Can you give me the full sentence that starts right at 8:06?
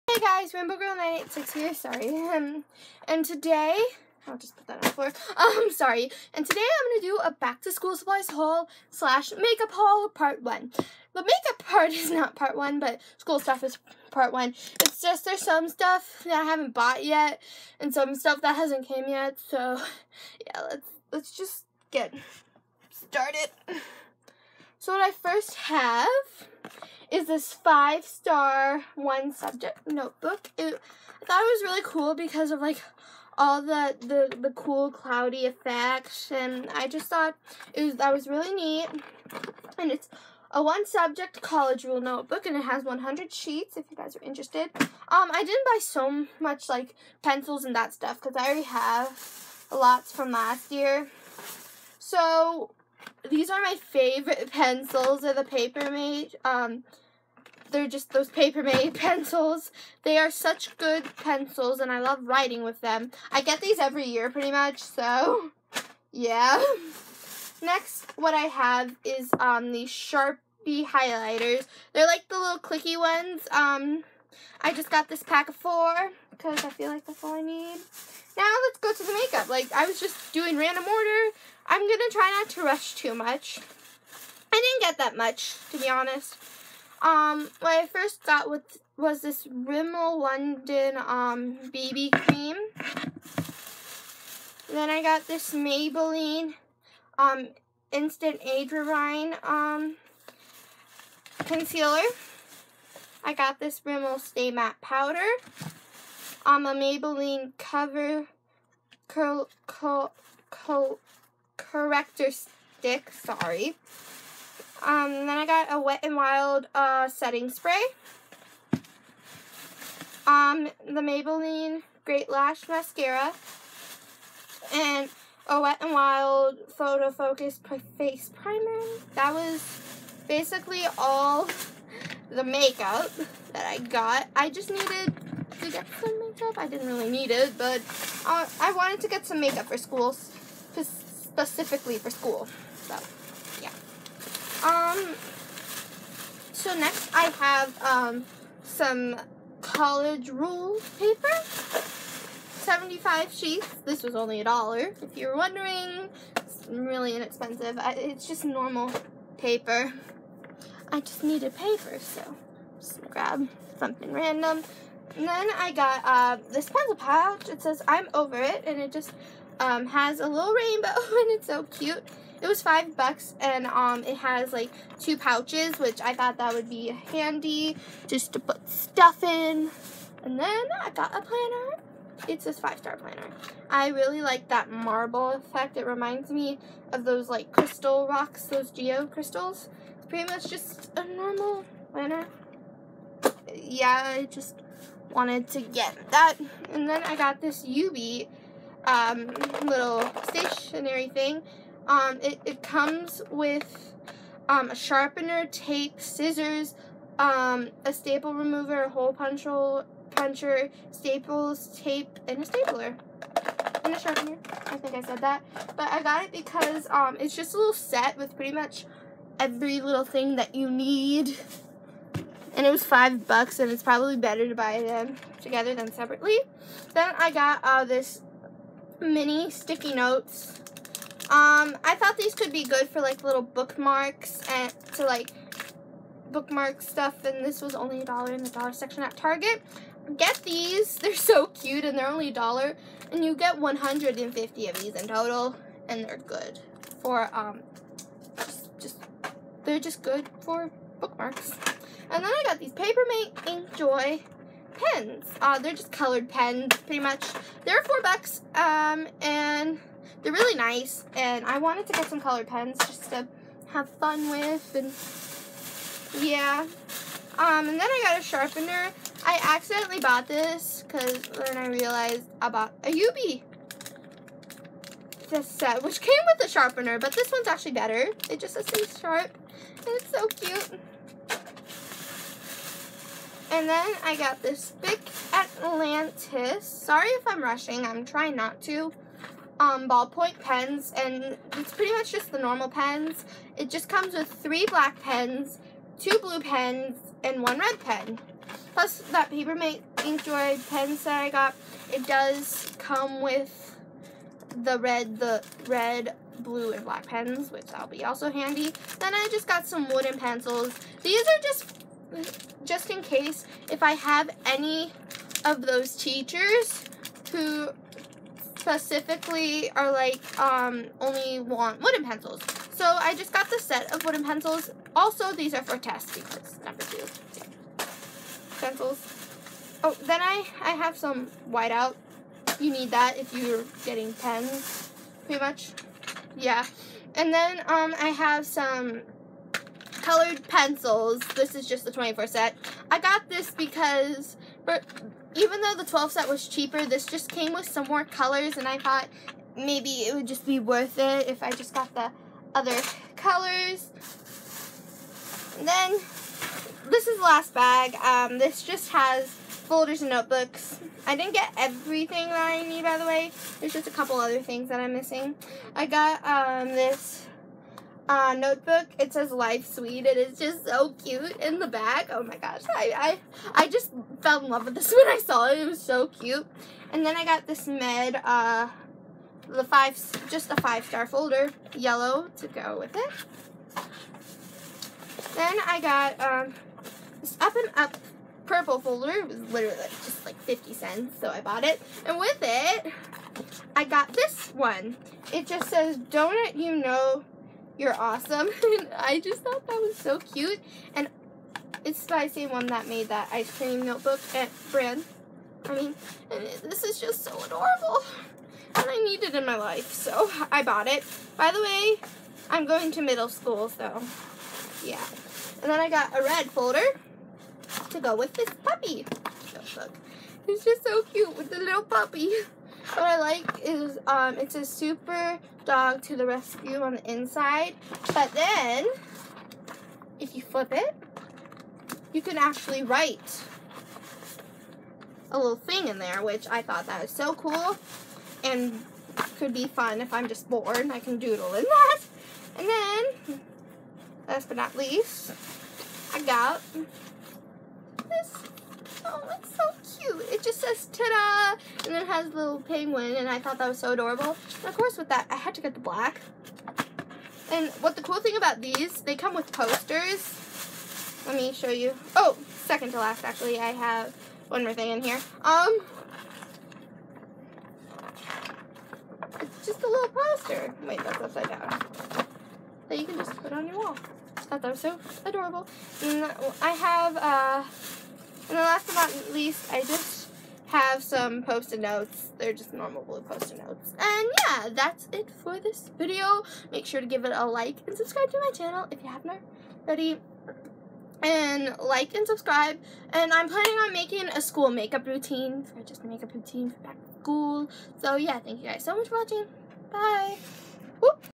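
Make sure to give it a like and subscribe to my channel if you haven't already.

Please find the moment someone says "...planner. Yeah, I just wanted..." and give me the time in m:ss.
3:11.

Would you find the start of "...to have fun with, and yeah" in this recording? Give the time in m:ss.
4:23.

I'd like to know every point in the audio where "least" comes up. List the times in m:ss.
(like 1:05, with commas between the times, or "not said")
7:24, 7:59.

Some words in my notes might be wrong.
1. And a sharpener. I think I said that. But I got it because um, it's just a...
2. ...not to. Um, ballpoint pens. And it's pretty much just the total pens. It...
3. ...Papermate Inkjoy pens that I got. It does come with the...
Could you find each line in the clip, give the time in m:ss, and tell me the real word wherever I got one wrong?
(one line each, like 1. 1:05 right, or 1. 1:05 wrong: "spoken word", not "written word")
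1. 3:33 right
2. 4:48 wrong: "normal", not "total"
3. 4:59 right.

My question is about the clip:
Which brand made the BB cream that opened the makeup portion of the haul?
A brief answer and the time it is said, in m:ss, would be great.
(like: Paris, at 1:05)
Rimmel London, at 1:29.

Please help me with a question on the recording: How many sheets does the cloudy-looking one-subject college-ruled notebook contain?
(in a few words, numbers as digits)
100.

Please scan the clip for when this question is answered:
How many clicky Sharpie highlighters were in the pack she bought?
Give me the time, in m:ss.
1:15.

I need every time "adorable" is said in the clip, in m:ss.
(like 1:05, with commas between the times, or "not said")
6:47, 7:33, 7:55.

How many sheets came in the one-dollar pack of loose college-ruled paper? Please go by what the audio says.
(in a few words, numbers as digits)
75.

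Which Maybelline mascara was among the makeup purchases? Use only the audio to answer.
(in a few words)
Great Lash.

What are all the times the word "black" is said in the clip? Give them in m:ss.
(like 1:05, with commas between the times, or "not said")
4:54, 5:06, 7:35.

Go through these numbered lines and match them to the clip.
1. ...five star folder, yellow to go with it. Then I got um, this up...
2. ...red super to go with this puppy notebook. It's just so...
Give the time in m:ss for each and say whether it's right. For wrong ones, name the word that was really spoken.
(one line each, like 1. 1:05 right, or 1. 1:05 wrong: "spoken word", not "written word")
1. 6:20 right
2. 6:56 wrong: "folder", not "super".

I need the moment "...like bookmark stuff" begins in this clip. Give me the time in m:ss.
3:55.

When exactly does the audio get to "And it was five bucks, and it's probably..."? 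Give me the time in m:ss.
3:42.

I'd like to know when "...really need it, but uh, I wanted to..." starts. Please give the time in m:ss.
2:16.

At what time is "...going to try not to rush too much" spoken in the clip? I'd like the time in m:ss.
1:21.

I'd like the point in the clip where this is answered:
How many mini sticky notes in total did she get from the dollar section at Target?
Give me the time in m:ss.
4:03.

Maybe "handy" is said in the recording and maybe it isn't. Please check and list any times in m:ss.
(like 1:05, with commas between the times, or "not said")
2:56, 5:08.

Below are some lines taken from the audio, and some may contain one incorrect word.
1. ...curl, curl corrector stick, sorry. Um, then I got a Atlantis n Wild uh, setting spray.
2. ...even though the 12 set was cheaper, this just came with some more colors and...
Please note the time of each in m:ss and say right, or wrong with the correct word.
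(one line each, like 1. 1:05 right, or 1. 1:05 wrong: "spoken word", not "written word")
1. 1:49 wrong: "Wet", not "Atlantis"
2. 5:45 right.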